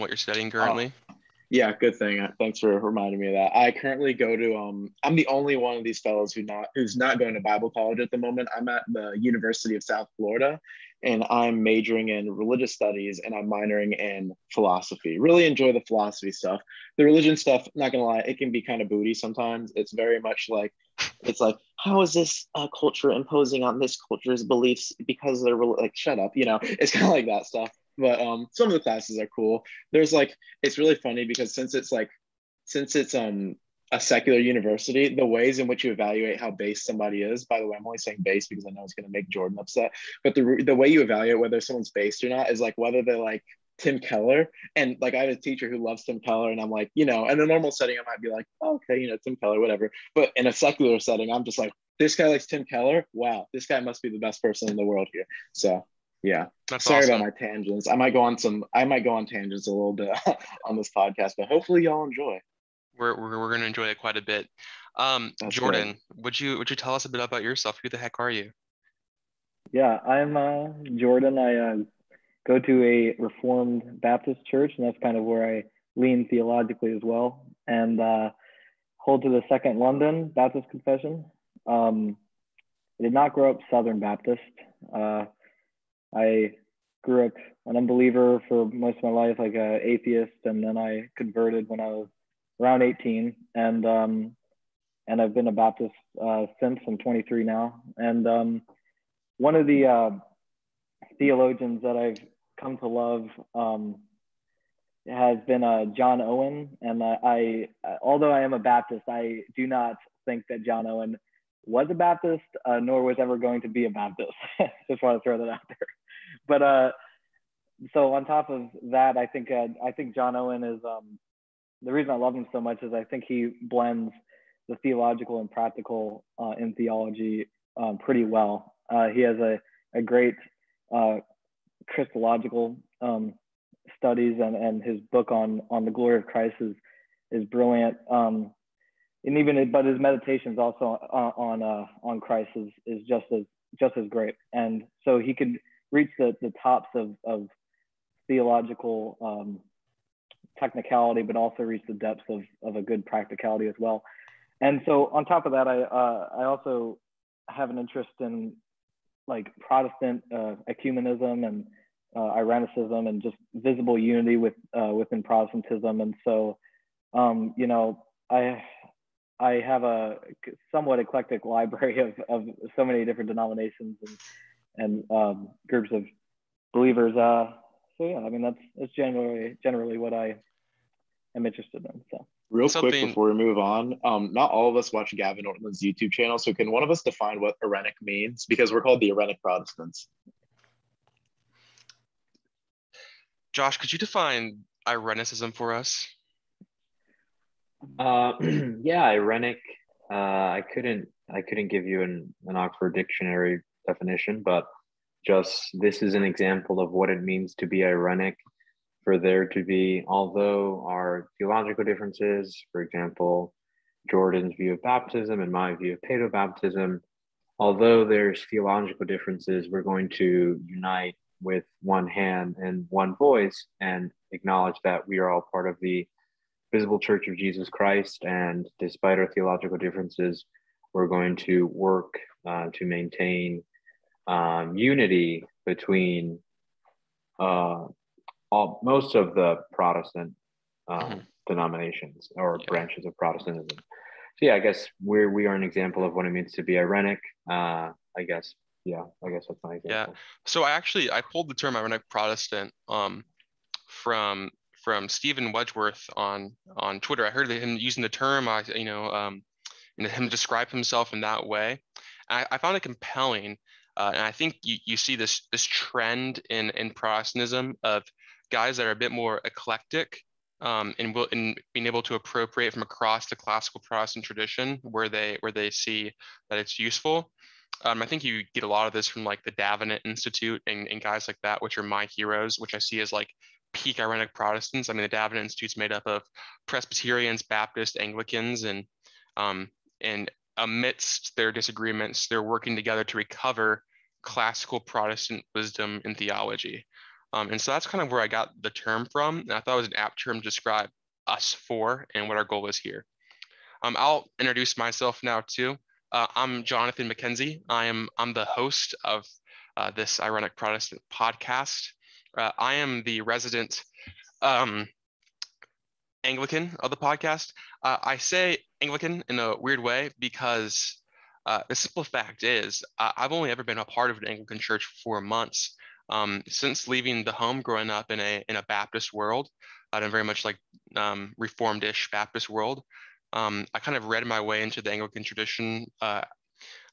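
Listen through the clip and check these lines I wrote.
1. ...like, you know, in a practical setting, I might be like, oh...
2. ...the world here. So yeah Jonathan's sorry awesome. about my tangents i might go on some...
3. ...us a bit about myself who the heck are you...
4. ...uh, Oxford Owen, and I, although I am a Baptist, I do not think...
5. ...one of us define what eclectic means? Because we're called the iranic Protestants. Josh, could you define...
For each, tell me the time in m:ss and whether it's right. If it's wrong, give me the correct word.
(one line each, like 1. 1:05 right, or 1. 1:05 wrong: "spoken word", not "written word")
1. 0:46 wrong: "normal", not "practical"
2. 0:54 wrong: "That", not "Jonathan"
3. 1:06 wrong: "yourself", not "myself"
4. 1:45 wrong: "John", not "Oxford"
5. 3:06 wrong: "iranic", not "eclectic".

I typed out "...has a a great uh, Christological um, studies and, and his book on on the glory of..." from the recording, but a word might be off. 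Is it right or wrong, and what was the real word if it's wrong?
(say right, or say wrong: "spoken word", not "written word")
right.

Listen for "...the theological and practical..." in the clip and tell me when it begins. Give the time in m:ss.
2:04.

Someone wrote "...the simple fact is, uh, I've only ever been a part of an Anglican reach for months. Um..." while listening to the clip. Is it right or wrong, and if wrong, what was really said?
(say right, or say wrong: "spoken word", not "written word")
wrong: "church", not "reach".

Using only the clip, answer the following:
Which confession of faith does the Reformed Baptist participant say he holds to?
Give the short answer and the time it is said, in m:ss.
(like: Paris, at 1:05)
Second London Baptist Confession, at 1:19.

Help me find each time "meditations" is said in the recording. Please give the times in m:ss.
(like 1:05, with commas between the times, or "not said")
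2:19.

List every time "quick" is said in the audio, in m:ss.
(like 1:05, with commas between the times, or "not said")
3:02.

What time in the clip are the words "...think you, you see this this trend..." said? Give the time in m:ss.
4:24.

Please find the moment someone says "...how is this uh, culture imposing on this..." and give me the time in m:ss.
0:21.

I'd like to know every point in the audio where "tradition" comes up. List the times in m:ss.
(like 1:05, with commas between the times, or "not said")
4:34, 5:35.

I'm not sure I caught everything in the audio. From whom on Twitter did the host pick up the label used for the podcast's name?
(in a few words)
Steven Wedgeworth.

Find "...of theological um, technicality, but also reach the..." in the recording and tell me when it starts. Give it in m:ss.
2:27.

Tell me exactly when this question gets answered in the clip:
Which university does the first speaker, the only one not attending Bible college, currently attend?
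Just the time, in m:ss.
0:09.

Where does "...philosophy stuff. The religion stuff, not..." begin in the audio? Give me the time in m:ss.
0:15.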